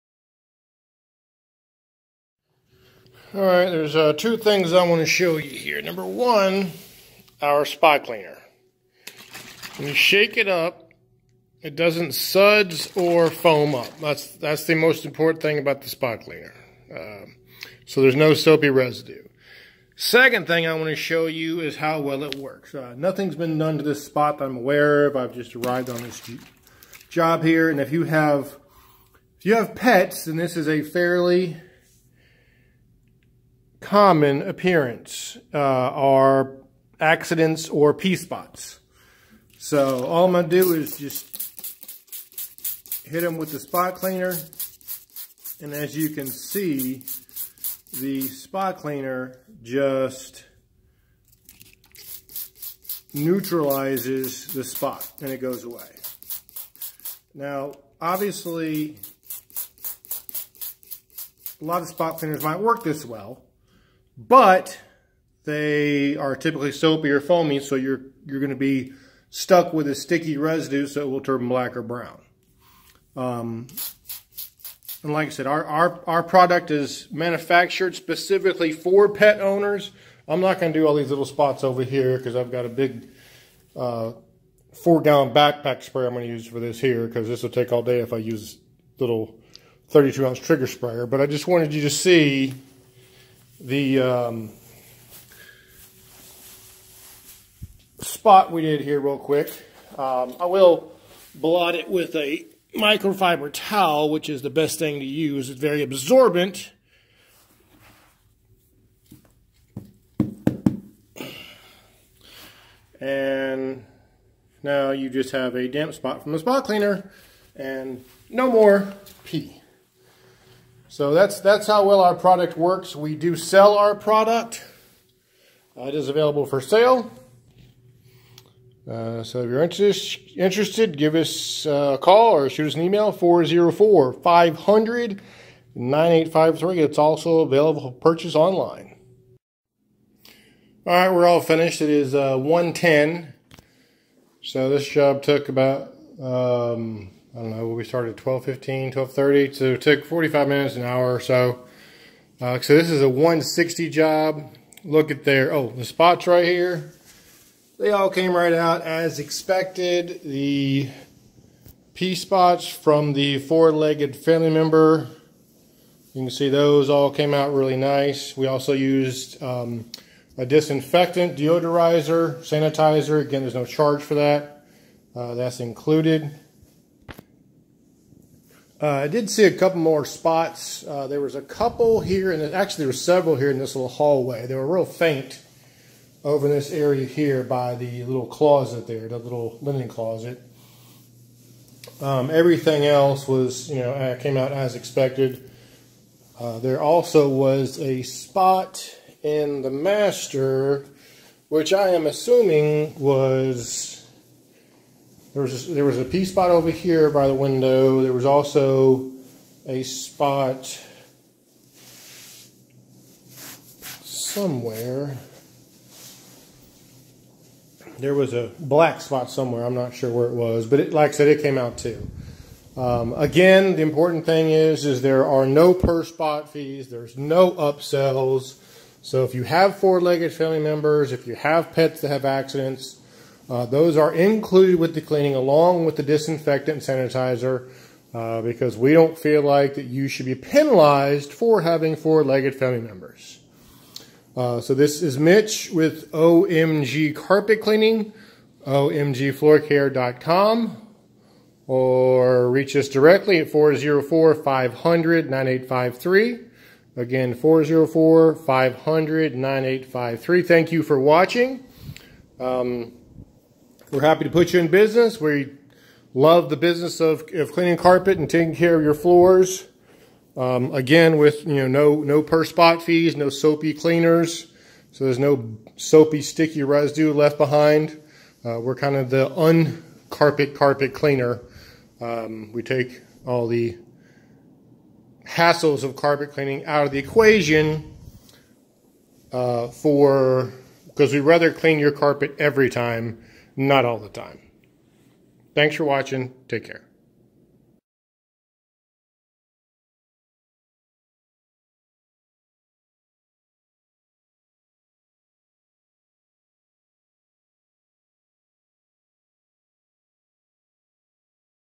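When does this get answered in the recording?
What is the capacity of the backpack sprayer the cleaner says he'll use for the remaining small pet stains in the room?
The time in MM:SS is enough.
01:24.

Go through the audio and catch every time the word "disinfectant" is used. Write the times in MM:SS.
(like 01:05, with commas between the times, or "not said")
02:50, 03:56.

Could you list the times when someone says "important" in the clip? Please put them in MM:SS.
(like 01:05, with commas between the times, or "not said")
00:15, 03:43.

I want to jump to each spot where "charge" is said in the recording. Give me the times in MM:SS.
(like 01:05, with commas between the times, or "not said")
02:53.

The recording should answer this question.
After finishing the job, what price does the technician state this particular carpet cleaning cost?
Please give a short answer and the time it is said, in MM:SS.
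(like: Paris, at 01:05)
160, at 02:33.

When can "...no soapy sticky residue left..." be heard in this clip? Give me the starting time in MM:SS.
04:35.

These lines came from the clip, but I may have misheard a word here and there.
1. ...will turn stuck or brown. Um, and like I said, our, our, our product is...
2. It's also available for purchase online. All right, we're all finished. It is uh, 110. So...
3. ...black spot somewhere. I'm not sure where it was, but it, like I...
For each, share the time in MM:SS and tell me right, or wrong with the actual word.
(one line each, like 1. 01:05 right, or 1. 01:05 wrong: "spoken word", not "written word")
1. 01:11 wrong: "black", not "stuck"
2. 02:16 right
3. 03:38 right.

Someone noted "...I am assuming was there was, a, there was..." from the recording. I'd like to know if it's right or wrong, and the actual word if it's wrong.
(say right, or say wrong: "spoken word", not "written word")
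right.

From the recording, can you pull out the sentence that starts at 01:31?
But I just wanted you to see the um, spot we did here real quick.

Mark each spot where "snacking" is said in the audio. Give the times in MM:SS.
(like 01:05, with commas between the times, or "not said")
not said.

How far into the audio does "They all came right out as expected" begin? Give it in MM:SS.
02:37.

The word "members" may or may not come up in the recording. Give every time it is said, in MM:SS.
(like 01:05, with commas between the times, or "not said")
02:44, 03:50, 04:02.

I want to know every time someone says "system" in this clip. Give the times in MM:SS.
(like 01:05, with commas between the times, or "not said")
not said.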